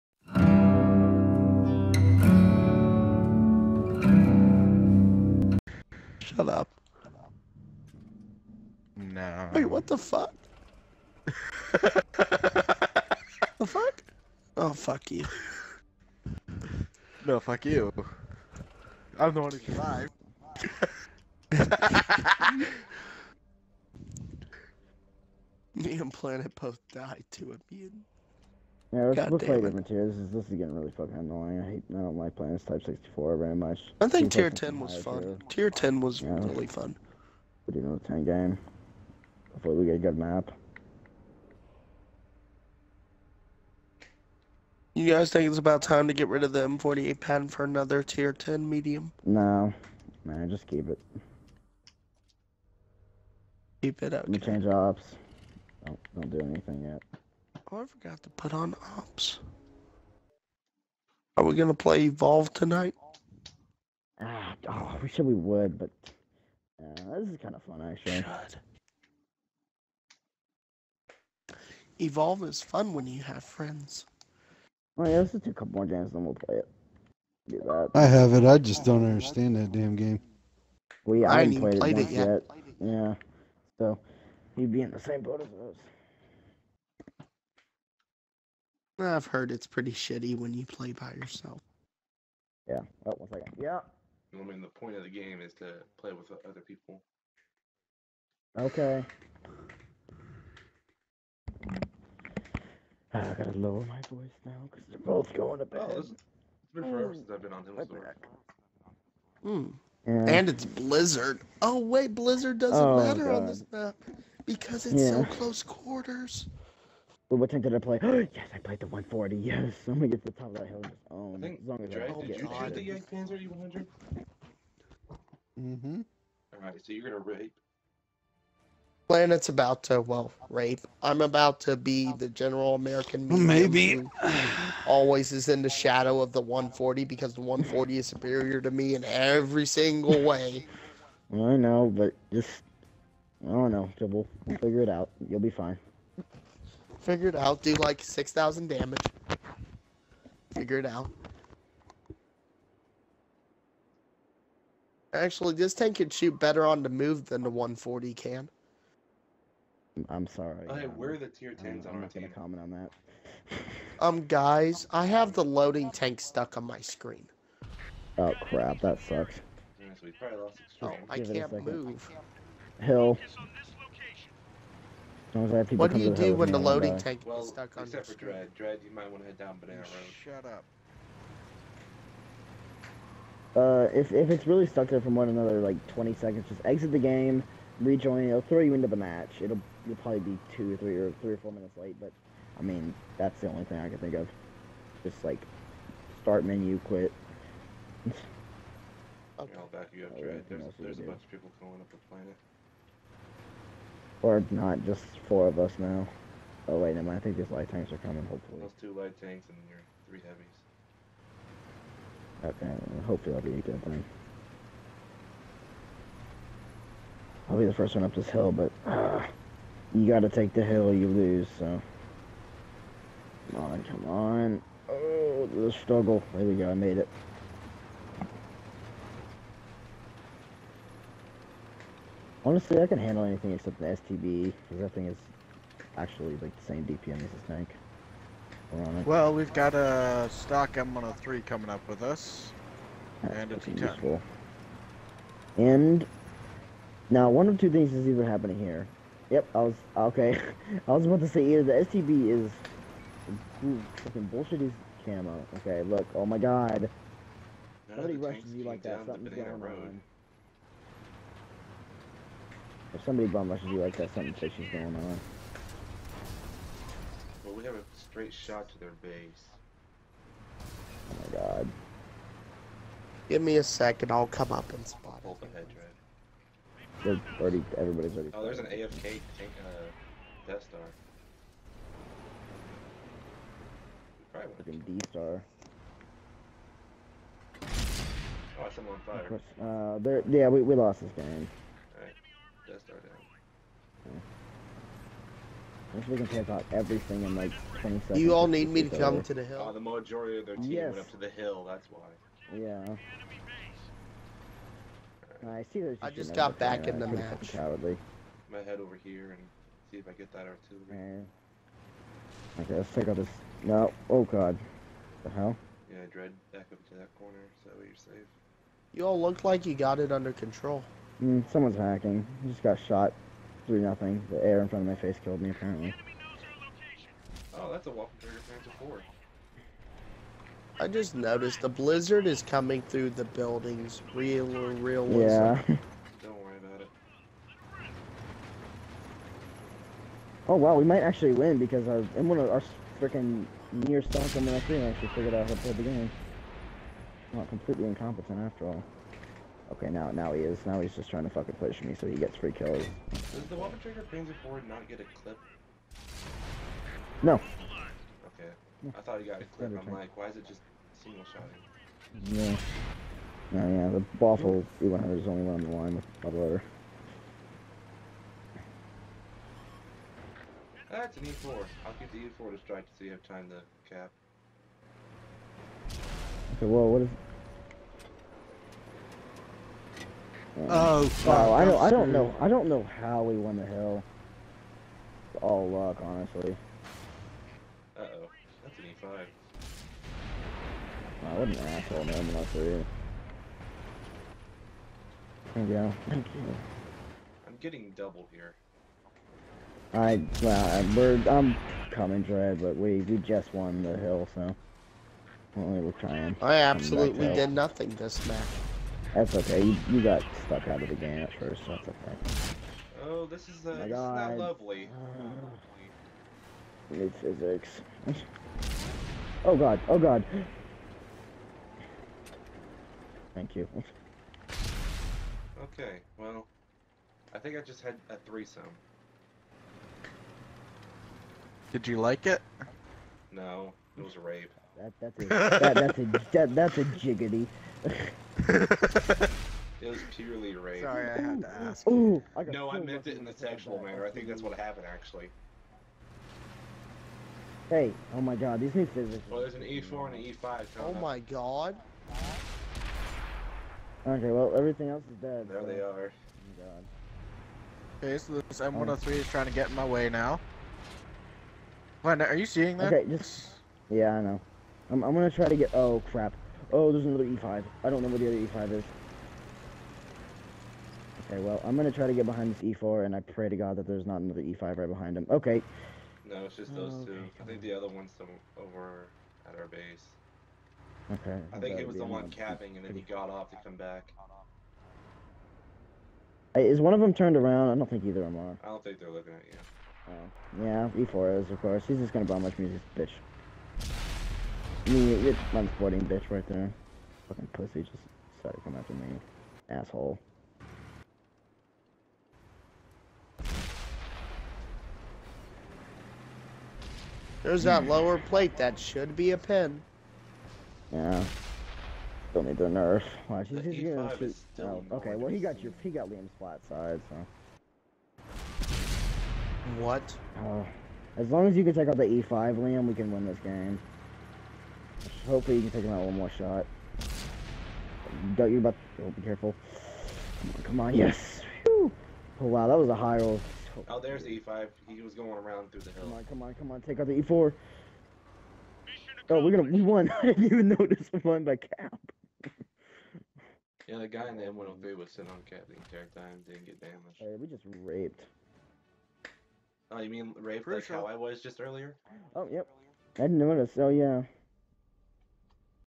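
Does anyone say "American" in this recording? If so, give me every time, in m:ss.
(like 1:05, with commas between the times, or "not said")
2:12.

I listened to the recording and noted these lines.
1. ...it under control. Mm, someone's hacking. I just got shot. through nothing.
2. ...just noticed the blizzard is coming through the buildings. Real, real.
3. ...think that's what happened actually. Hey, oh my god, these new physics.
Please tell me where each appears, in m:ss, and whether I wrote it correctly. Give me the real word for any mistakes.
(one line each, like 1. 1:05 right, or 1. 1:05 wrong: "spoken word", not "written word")
1. 5:19 right
2. 5:30 right
3. 7:24 right.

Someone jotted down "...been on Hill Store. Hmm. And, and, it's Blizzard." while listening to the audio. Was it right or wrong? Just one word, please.
right.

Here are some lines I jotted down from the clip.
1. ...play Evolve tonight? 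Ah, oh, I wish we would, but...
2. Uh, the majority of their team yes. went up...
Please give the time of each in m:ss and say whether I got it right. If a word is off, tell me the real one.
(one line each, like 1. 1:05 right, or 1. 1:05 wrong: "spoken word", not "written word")
1. 1:01 right
2. 4:59 right.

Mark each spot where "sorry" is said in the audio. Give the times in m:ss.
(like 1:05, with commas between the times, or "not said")
2:40, 7:20.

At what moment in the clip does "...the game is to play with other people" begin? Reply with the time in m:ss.
1:35.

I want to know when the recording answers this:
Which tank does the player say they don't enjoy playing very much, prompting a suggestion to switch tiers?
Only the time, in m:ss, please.
0:32.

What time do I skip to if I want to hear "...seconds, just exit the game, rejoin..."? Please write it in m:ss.
3:06.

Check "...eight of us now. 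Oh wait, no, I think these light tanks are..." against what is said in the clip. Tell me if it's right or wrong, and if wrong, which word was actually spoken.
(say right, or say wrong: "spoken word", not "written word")
wrong: "four", not "eight".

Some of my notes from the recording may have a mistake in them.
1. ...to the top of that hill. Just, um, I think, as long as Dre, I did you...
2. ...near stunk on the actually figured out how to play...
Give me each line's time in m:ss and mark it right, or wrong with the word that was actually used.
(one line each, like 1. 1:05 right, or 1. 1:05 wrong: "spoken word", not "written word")
1. 2:00 right
2. 5:43 right.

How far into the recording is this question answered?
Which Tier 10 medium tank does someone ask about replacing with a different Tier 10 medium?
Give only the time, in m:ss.
0:46.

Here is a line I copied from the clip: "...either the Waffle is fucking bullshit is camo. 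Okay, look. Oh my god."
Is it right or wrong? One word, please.
wrong.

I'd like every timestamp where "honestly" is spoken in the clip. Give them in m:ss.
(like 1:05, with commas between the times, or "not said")
3:52, 6:26.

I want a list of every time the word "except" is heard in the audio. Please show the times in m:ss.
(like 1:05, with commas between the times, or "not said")
2:57, 3:53.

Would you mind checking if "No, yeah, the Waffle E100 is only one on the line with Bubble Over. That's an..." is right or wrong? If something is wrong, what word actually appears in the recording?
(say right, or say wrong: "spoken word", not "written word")
right.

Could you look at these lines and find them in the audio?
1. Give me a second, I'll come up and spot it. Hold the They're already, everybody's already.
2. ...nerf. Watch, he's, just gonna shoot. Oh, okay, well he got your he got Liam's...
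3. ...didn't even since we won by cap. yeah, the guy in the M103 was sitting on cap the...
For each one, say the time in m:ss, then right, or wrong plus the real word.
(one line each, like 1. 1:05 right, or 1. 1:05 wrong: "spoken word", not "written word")
1. 4:33 right
2. 8:32 right
3. 9:00 wrong: "notice", not "since".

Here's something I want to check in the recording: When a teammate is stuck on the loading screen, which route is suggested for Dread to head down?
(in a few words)
Banana Road.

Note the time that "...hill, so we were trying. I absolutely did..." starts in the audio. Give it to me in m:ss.
6:43.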